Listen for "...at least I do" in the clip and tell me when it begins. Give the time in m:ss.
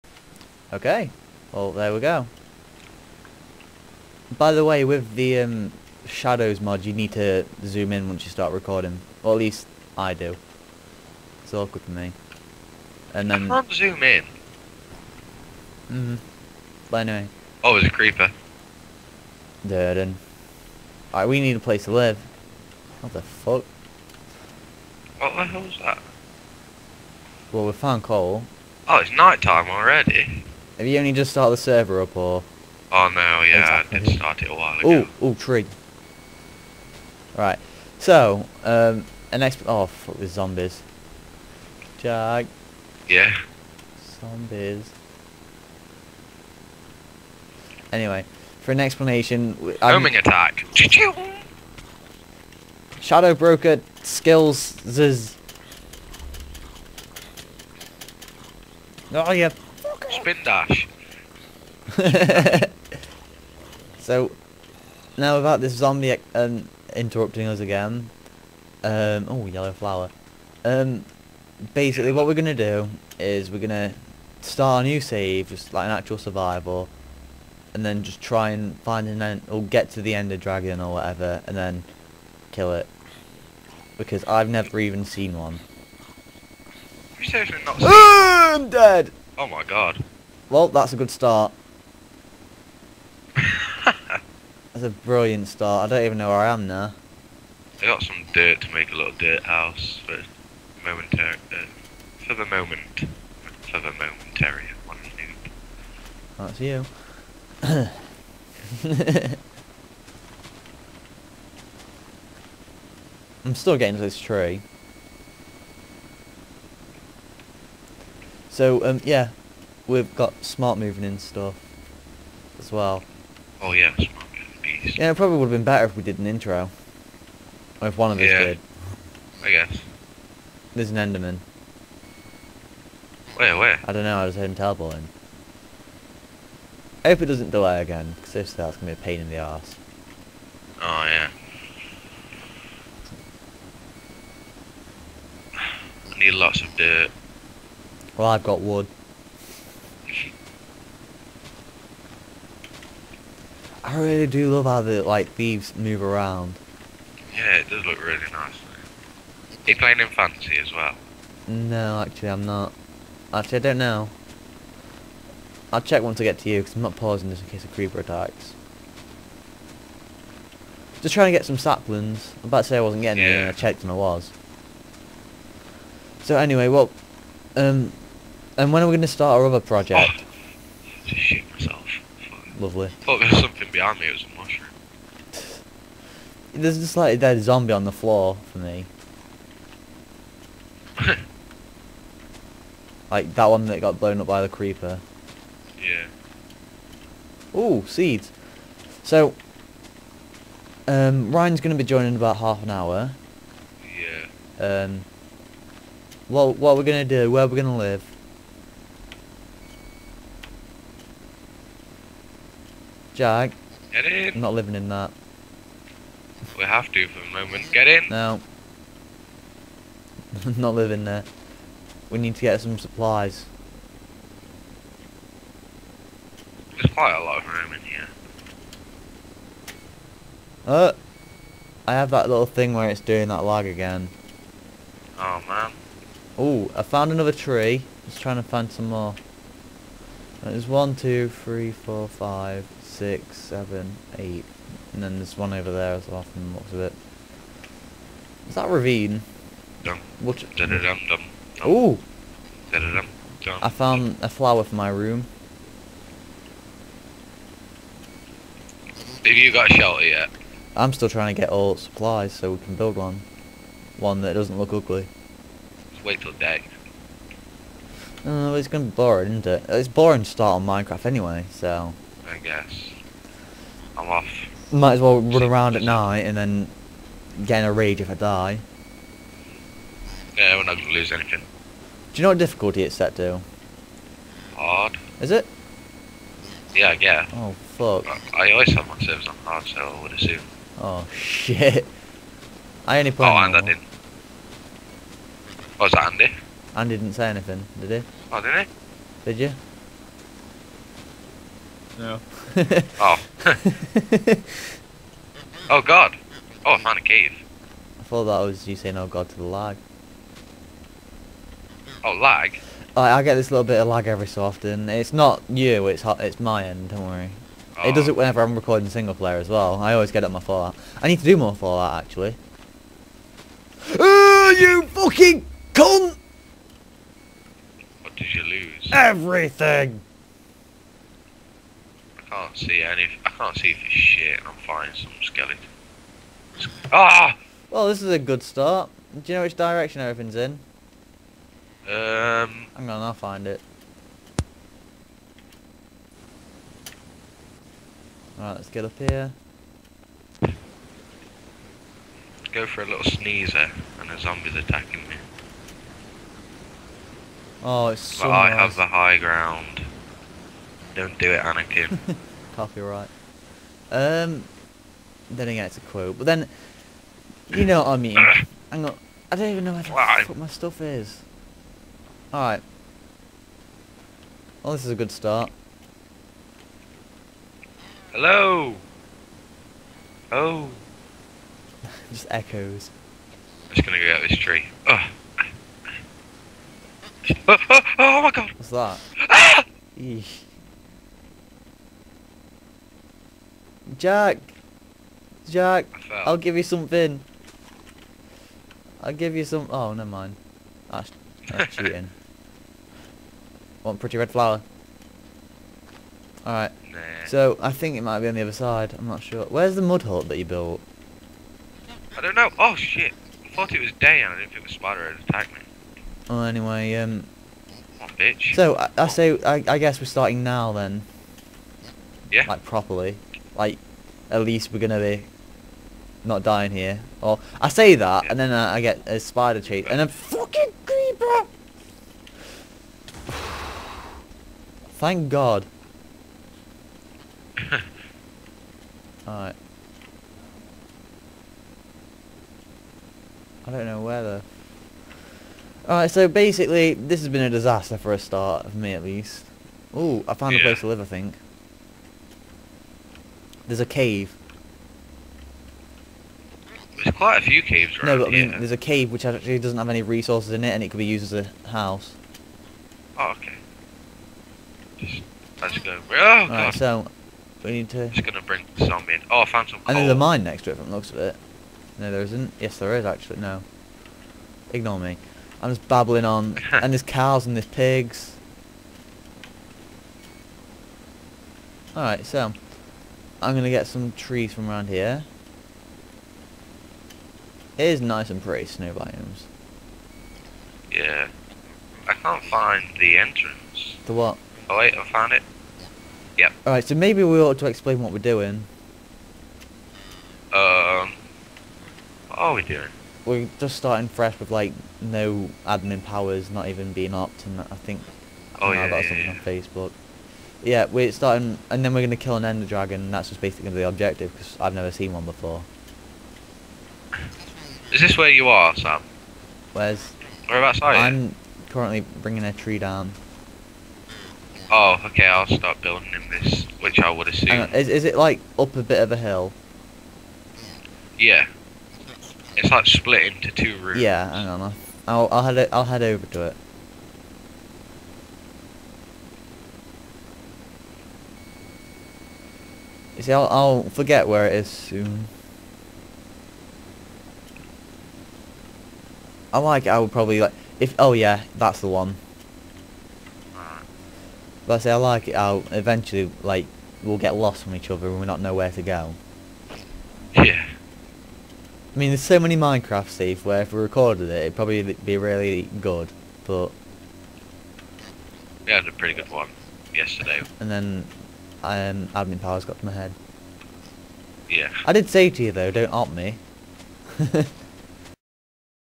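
0:09.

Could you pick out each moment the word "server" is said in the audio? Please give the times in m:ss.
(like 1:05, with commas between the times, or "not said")
0:31, 4:48.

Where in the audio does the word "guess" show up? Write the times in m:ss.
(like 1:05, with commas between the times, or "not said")
2:09, 4:32, 6:59.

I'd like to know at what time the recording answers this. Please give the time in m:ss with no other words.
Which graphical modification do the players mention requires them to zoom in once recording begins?
0:06.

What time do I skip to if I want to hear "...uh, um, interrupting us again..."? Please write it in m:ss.
1:06.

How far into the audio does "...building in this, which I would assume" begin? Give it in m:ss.
8:45.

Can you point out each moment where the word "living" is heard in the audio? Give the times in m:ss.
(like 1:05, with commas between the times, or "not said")
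3:34, 3:40.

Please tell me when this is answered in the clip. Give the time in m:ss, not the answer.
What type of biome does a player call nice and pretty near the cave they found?
8:08.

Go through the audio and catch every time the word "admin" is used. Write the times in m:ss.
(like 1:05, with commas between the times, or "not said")
8:25, 9:32.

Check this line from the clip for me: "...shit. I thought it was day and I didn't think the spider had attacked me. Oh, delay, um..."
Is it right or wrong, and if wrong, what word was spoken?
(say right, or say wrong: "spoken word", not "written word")
wrong: "anyway", not "delay".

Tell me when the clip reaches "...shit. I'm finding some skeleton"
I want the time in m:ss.
5:33.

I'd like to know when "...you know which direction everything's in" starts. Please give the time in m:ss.
5:39.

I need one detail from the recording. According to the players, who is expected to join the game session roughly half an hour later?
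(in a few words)
Ryan.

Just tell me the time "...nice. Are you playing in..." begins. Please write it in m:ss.
2:38.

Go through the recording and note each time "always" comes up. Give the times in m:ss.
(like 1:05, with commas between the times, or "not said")
4:48, 5:19.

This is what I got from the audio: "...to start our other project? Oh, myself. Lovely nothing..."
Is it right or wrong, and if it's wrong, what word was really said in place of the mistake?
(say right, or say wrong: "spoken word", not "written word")
right.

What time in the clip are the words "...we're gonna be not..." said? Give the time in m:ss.
7:04.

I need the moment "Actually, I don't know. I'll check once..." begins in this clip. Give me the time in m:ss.
2:43.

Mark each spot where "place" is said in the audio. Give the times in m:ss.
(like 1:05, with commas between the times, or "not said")
0:21, 7:30.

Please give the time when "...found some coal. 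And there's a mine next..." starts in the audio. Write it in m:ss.
7:49.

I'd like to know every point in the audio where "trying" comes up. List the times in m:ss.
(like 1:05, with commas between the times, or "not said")
2:51, 3:58, 4:21.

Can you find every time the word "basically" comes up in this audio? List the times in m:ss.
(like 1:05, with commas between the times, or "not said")
1:11, 7:26, 8:33.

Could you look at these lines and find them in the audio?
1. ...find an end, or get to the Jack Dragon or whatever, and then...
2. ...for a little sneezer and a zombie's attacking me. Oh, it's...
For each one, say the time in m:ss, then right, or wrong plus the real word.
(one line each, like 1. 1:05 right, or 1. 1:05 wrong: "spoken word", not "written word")
1. 1:18 wrong: "Ender", not "Jack"
2. 5:52 right.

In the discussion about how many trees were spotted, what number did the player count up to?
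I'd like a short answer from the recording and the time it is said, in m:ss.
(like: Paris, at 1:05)
8, at 4:04.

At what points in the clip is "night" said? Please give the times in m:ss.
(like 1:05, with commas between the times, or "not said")
0:29, 4:35.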